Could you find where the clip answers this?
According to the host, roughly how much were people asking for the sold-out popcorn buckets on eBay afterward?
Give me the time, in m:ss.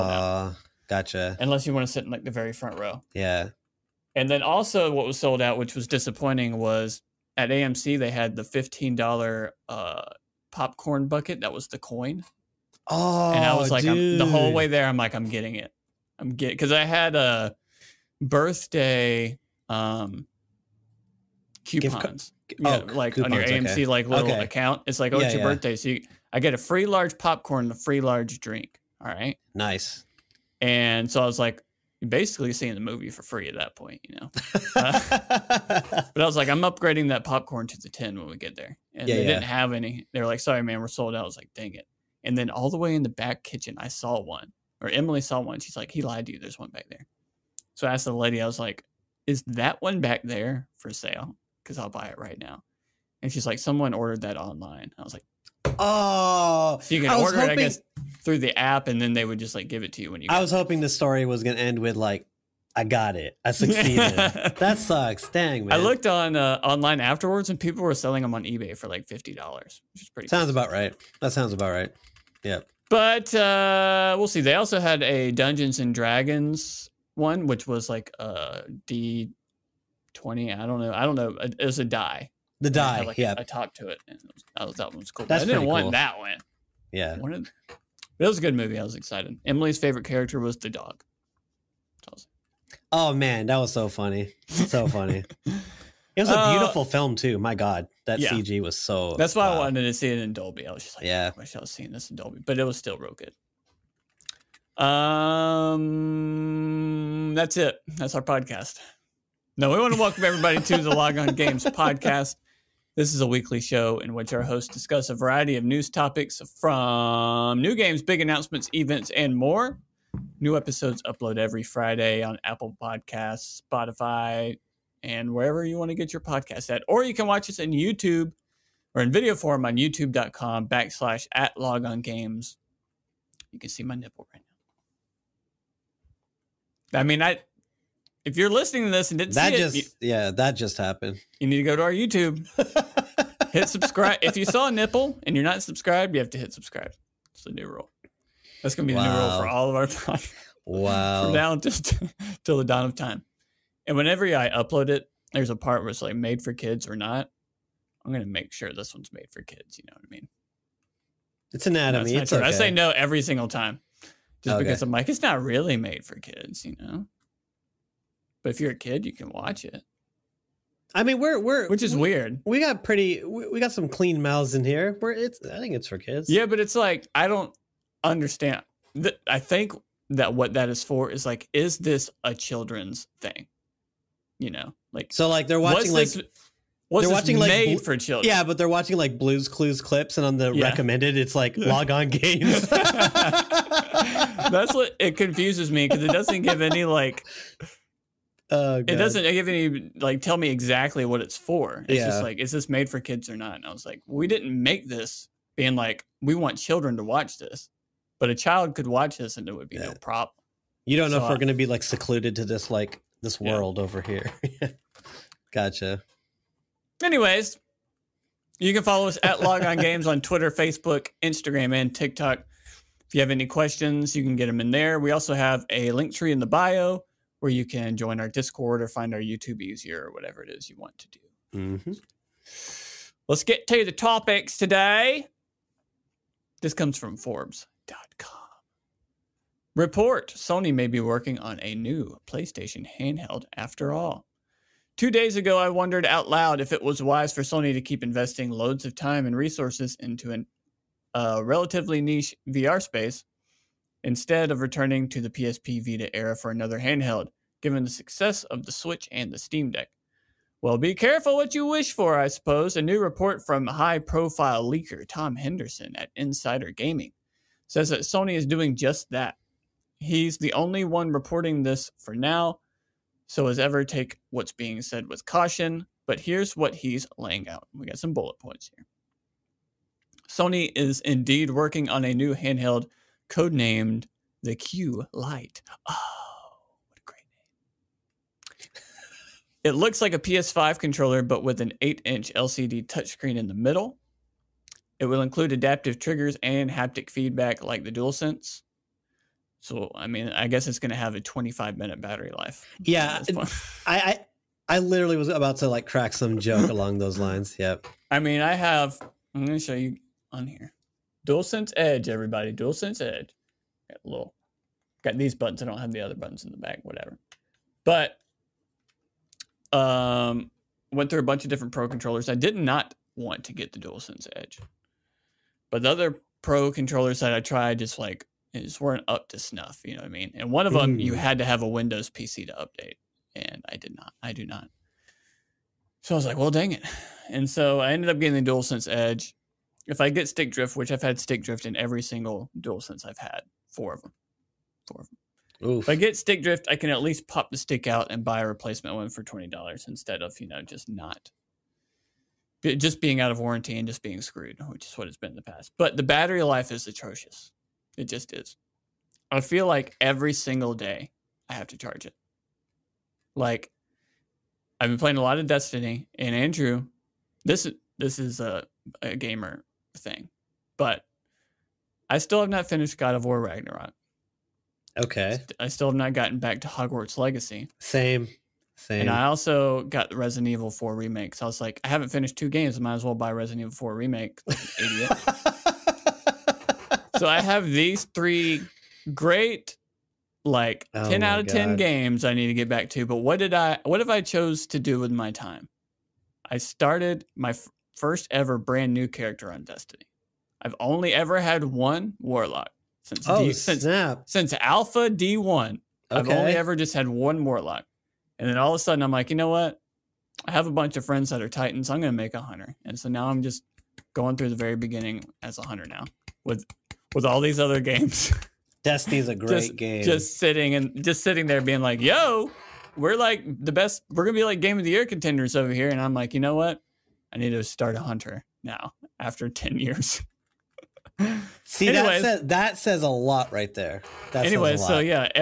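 1:09.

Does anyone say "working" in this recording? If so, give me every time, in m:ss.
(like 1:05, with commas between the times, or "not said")
4:00, 4:41.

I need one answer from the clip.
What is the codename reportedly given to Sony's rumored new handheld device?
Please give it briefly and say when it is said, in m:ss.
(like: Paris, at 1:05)
Q Lite, at 4:44.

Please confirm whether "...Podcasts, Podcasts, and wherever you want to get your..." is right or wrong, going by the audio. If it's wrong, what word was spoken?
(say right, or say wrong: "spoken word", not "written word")
wrong: "Spotify", not "Podcasts".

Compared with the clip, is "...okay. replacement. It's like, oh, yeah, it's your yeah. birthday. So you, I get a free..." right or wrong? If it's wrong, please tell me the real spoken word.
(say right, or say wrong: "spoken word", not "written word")
wrong: "account", not "replacement".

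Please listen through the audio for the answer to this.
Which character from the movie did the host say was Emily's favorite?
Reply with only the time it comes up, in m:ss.
1:30.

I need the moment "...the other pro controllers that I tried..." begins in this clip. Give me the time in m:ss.
5:25.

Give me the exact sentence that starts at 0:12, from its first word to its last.
Oh, and I oh, was like, the whole way there, I'm like, I'm getting it.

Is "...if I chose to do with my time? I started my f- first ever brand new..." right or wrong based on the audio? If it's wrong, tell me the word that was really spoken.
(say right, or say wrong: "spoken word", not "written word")
right.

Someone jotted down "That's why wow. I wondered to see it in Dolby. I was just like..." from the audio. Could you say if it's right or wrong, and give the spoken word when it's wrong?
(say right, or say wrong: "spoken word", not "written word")
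wrong: "wanted", not "wondered".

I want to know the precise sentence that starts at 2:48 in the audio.
But if you're a kid, you can watch it.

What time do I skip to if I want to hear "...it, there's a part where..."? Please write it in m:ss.
2:34.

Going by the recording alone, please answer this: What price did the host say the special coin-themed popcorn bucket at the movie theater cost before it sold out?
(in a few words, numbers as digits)
$15.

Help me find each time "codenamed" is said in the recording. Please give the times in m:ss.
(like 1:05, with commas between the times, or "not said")
4:43.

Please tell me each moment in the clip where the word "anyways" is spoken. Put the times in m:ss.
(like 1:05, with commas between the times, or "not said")
3:37, 7:14.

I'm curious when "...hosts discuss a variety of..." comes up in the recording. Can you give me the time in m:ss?
1:54.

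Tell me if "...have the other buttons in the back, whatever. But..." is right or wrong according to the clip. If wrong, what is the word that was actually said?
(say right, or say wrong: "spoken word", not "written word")
right.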